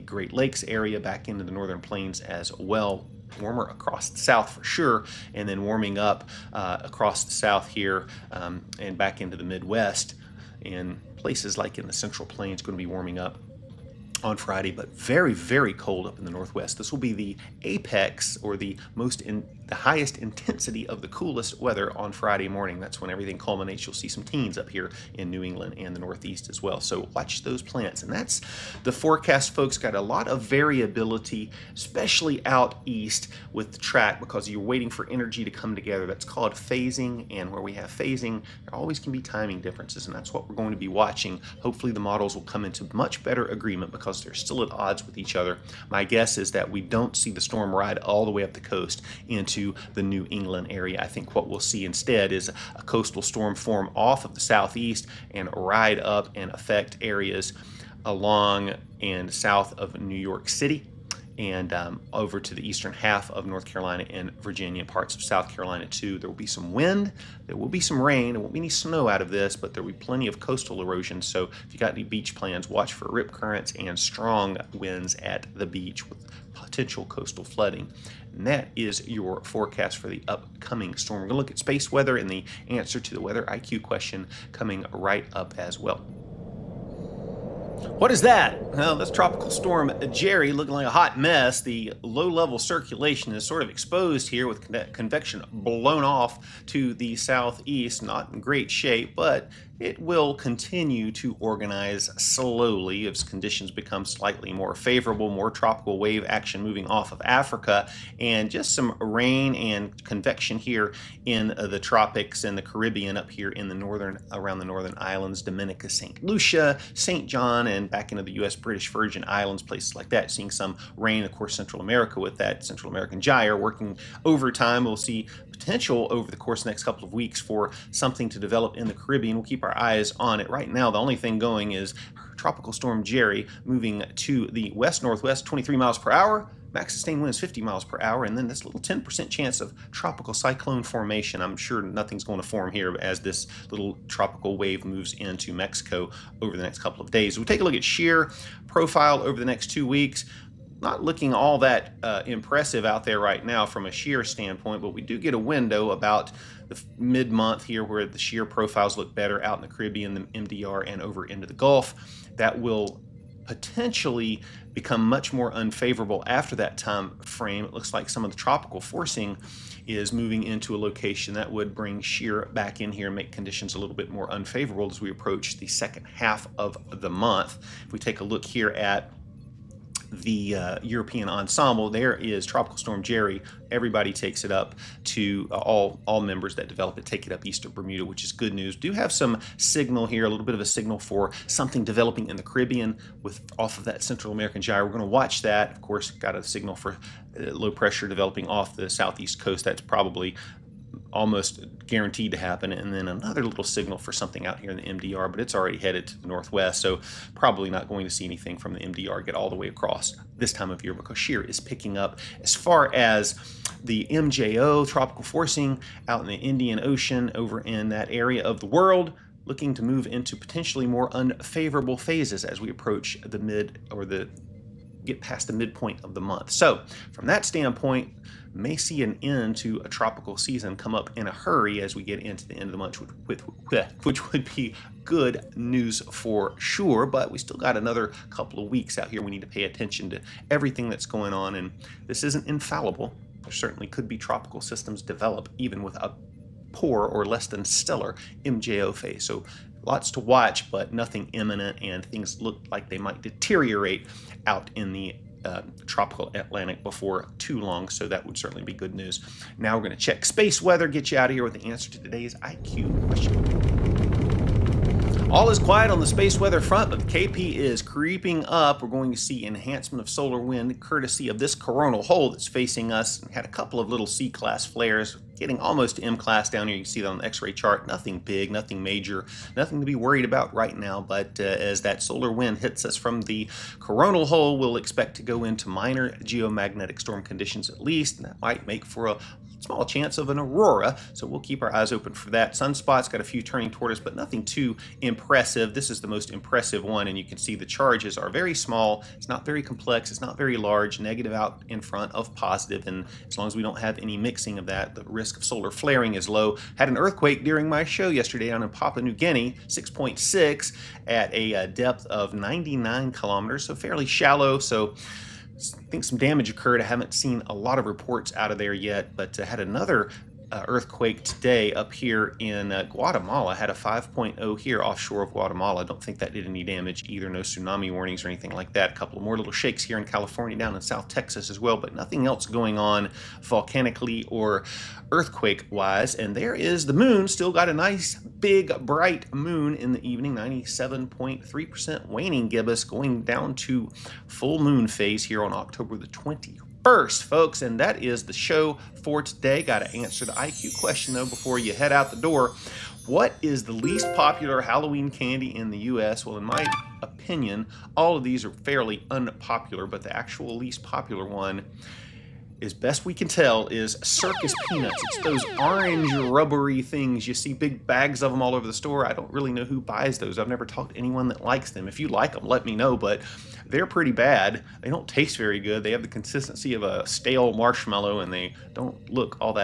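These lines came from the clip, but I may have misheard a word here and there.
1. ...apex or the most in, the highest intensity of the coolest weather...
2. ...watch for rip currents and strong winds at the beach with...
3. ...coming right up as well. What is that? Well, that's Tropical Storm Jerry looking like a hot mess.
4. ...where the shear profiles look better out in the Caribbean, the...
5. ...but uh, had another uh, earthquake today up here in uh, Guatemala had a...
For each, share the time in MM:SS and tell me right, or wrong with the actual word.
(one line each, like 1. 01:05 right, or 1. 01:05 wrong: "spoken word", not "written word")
1. 00:17 right
2. 01:12 right
3. 01:24 right
4. 02:37 right
5. 05:19 right.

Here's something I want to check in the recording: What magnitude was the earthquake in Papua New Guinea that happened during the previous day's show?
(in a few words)
6.6.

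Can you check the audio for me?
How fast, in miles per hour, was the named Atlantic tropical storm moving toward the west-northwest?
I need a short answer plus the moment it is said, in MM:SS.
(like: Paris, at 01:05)
23 mph, at 02:15.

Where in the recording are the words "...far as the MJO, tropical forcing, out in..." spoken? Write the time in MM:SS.
03:32.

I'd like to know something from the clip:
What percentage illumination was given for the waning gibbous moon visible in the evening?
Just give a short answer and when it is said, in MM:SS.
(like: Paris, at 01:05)
97.3%, at 05:40.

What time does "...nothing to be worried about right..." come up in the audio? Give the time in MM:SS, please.
04:39.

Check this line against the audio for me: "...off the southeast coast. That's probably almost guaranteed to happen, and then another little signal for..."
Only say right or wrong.
right.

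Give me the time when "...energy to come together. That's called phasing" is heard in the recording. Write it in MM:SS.
00:35.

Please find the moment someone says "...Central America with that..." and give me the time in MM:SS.
02:01.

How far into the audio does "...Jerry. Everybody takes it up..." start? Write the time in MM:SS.
03:03.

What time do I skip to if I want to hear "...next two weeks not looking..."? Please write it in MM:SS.
02:29.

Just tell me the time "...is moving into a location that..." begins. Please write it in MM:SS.
02:49.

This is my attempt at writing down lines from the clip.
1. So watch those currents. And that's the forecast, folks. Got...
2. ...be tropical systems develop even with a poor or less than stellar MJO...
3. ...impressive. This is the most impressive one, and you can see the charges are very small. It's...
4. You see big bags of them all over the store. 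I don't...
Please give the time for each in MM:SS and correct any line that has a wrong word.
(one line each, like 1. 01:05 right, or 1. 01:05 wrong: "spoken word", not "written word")
1. 00:26 wrong: "plants", not "currents"
2. 04:04 right
3. 04:55 right
4. 06:07 right.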